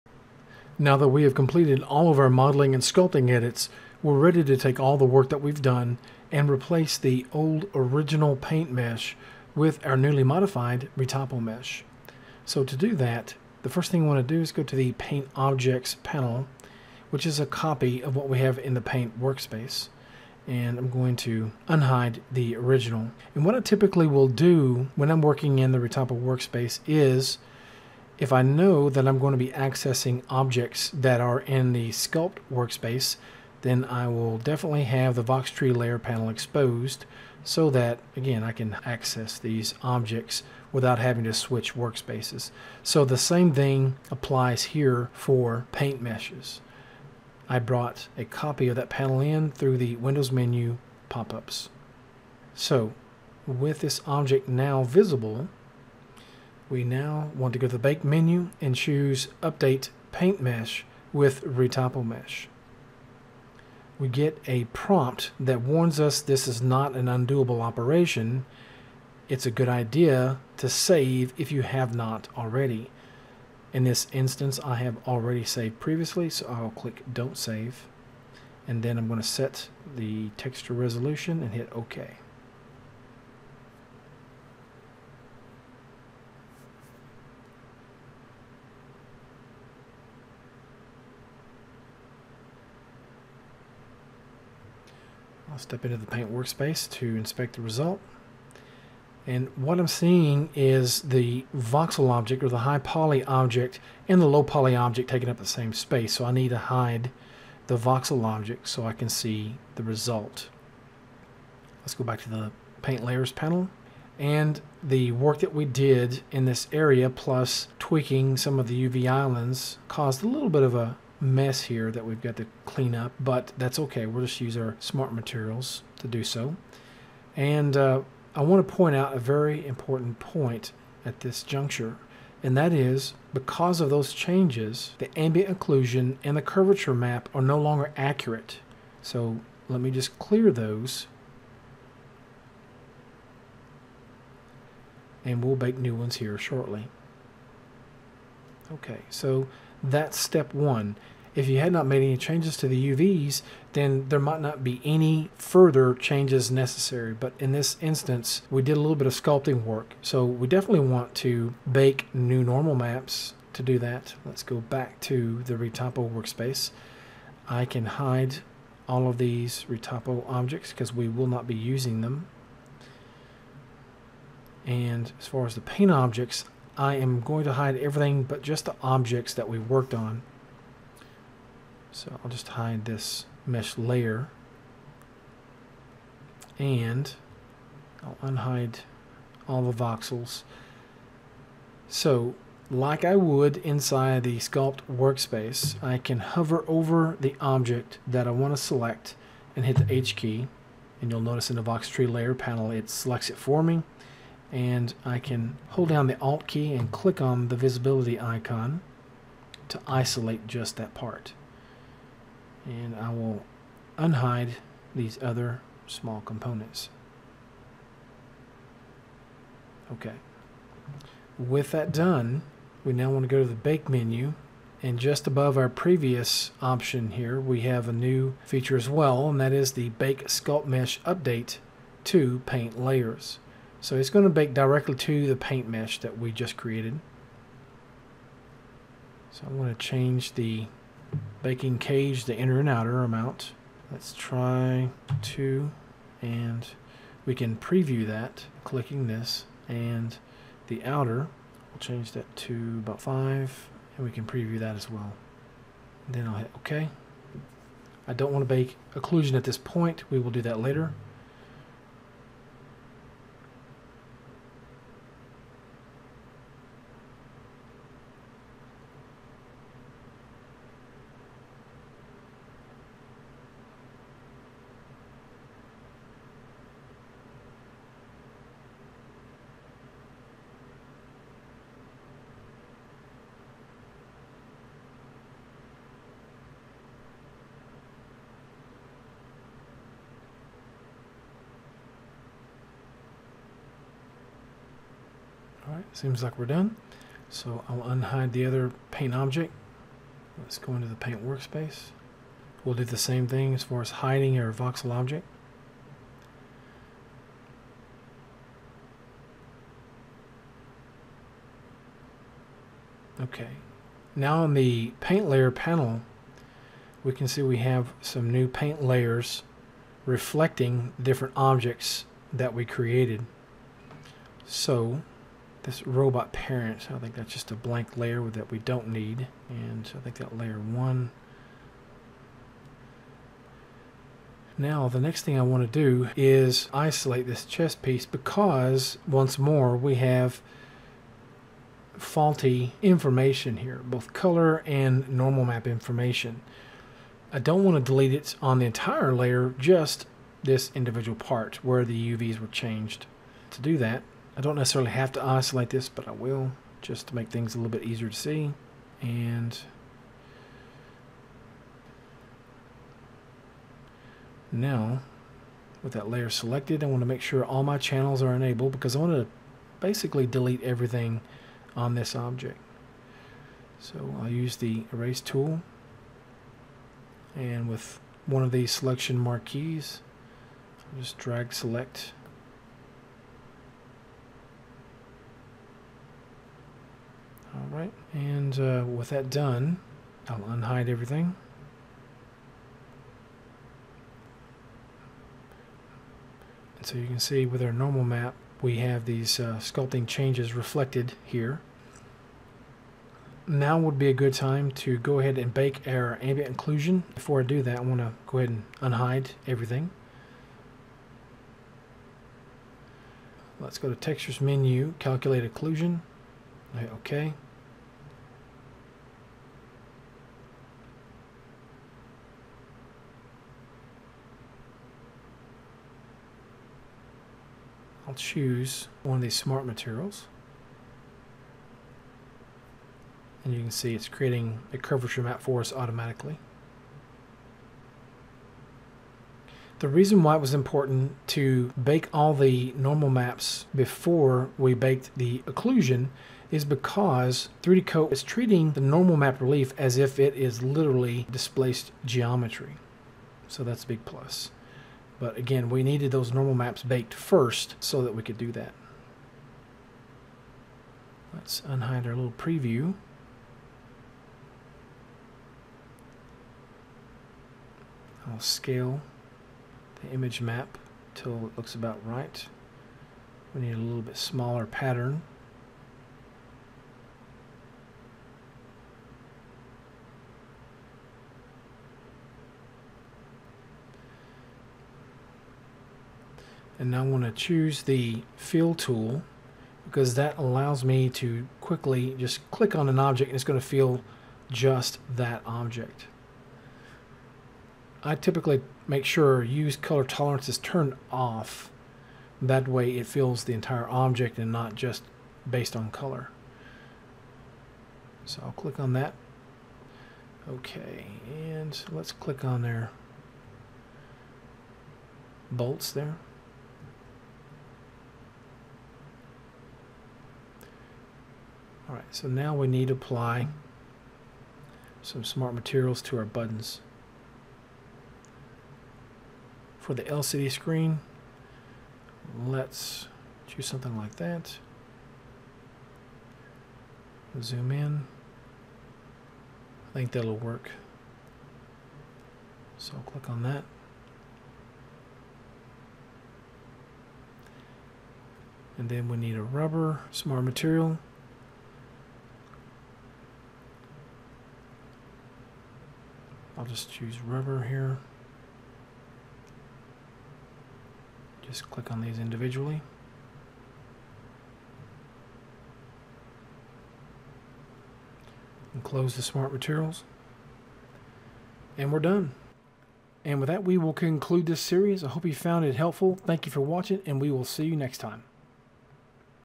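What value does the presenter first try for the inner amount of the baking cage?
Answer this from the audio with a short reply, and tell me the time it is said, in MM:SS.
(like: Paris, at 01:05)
2, at 04:05.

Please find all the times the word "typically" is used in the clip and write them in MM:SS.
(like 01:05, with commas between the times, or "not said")
00:23, 08:18.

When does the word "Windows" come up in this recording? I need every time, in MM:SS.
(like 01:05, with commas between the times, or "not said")
00:49.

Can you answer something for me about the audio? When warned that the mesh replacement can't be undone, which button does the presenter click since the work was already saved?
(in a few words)
Don't Save.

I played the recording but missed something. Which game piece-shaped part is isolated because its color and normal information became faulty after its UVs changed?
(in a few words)
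chess piece.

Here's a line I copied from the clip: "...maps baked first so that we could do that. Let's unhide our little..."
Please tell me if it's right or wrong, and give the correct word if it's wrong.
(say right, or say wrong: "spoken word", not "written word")
right.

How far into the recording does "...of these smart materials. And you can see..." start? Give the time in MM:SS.
07:09.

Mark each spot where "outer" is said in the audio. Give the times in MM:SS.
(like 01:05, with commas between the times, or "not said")
04:02, 04:10.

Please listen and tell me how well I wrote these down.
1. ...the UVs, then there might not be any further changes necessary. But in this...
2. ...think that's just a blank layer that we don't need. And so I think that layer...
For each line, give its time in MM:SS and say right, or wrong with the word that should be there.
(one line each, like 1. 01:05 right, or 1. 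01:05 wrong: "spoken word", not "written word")
1. 02:32 right
2. 05:26 right.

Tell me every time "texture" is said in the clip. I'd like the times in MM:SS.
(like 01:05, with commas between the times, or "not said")
01:20, 06:53.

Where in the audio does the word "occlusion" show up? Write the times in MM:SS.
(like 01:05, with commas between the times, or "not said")
02:15, 04:18, 06:46, 06:55, 07:25.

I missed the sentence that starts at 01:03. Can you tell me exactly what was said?
We get a prompt that warns us this is not an undoable operation.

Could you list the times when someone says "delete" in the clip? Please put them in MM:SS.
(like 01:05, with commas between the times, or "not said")
05:47, 06:10.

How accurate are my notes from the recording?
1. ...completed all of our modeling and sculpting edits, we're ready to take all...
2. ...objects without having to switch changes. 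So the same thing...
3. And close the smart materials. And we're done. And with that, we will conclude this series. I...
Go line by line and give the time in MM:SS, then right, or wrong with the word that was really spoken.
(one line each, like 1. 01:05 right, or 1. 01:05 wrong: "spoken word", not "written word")
1. 00:01 right
2. 00:39 wrong: "workspaces", not "changes"
3. 09:28 right.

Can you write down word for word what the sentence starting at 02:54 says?
And as far as the paint objects, I am going to hide everything but just the objects that we worked on.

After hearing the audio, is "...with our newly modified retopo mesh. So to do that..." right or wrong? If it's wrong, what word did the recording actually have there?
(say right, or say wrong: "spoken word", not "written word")
right.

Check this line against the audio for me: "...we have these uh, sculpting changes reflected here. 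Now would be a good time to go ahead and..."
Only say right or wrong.
right.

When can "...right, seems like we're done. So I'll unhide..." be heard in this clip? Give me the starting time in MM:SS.
04:55.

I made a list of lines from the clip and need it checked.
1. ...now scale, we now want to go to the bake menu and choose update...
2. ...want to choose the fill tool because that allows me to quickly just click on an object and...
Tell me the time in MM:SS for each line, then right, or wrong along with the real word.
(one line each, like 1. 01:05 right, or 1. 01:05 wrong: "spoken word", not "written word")
1. 00:54 wrong: "visible", not "scale"
2. 08:07 right.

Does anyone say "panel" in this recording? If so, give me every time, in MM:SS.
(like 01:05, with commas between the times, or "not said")
00:16, 00:35, 00:48, 01:53, 03:22, 05:15.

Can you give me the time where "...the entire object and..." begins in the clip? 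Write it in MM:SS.
08:23.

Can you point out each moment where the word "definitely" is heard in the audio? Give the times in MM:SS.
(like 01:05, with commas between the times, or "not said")
00:34, 02:40.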